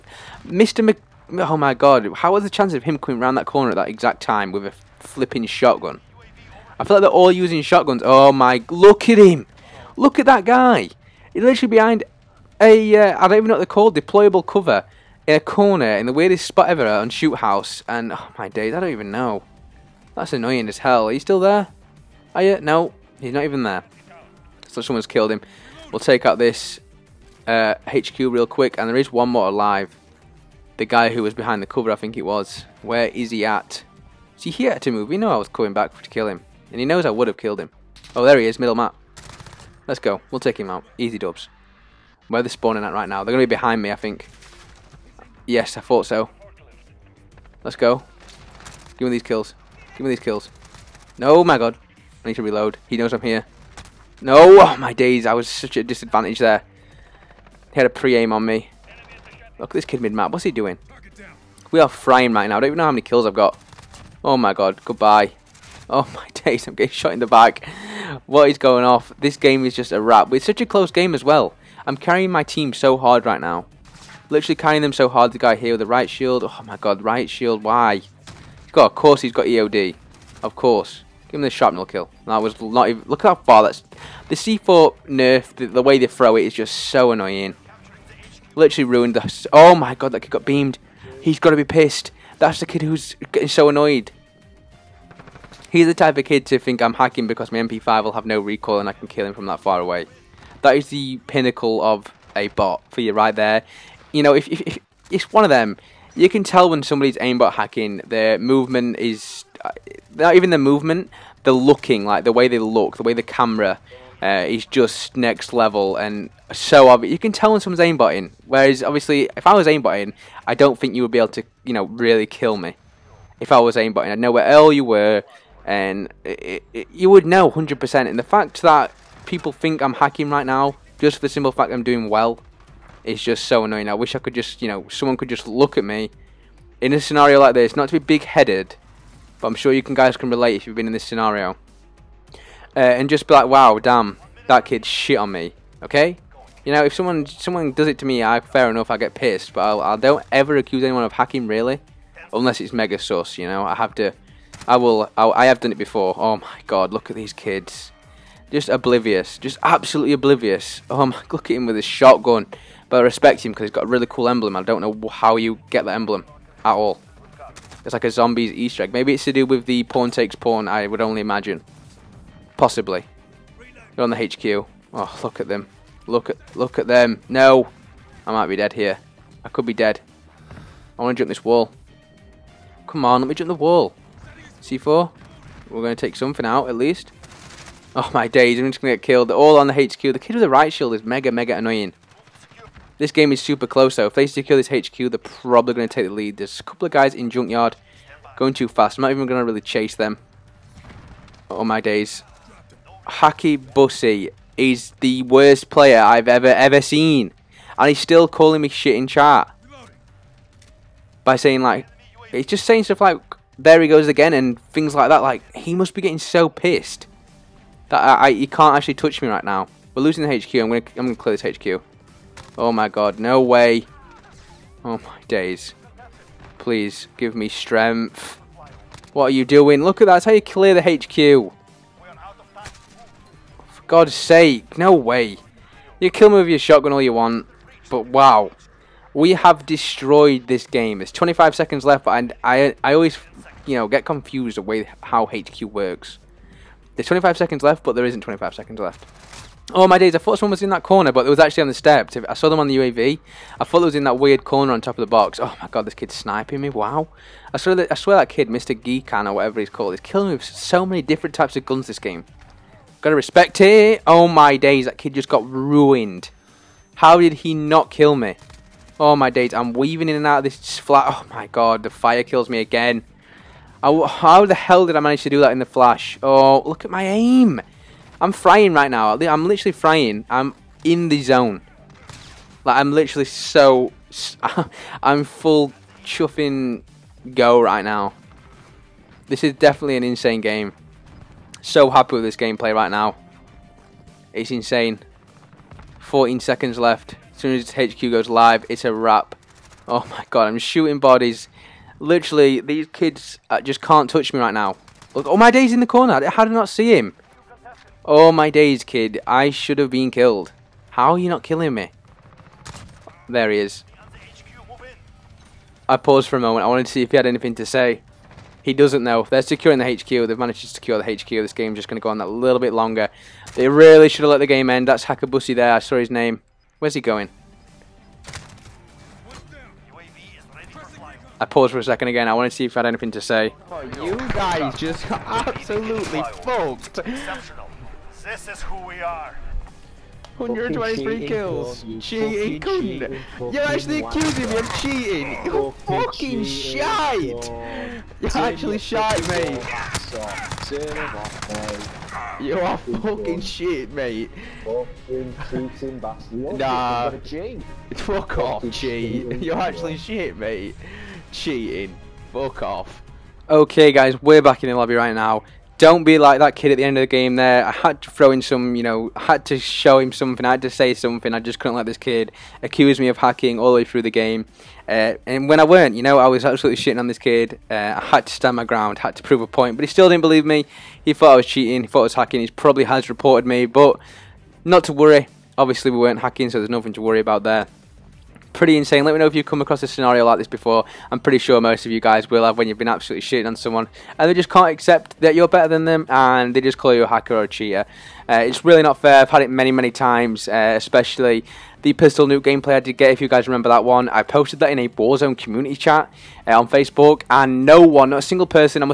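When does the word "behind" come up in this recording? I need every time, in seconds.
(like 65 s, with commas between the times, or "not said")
11 s, 31 s, 43 s.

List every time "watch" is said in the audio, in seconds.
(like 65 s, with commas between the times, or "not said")
not said.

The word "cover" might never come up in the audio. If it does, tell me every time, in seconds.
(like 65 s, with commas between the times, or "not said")
14 s, 31 s.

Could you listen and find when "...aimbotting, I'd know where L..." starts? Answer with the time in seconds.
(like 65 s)
123 s.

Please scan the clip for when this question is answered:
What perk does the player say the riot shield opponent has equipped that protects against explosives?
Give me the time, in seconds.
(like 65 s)
79 s.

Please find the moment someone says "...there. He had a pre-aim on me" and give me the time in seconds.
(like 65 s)
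56 s.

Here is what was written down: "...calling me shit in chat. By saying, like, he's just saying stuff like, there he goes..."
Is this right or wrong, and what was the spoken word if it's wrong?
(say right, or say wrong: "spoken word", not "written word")
right.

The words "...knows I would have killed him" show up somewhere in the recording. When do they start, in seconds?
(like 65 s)
36 s.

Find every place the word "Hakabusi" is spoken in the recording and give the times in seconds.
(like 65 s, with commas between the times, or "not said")
325 s.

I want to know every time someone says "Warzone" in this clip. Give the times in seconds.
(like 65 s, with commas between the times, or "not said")
404 s.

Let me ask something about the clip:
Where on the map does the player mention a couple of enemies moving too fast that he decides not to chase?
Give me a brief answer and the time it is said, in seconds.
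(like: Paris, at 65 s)
Junkyard, at 197 s.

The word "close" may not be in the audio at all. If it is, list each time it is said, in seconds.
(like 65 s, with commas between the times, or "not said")
70 s, 193 s.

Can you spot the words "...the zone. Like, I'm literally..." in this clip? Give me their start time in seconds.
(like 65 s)
281 s.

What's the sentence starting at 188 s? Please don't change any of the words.
I'm just going to get killed.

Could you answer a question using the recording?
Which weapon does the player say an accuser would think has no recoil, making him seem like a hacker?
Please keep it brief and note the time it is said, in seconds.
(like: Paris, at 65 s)
MP5, at 97 s.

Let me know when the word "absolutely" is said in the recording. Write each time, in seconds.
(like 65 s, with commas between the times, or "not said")
159 s, 335 s, 376 s, 392 s.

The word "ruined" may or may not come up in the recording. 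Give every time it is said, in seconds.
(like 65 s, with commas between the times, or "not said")
88 s, 265 s.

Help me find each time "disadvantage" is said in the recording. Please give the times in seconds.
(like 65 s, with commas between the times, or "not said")
55 s.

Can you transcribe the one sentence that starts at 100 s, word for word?
That is the pinnacle of a bot for you right there.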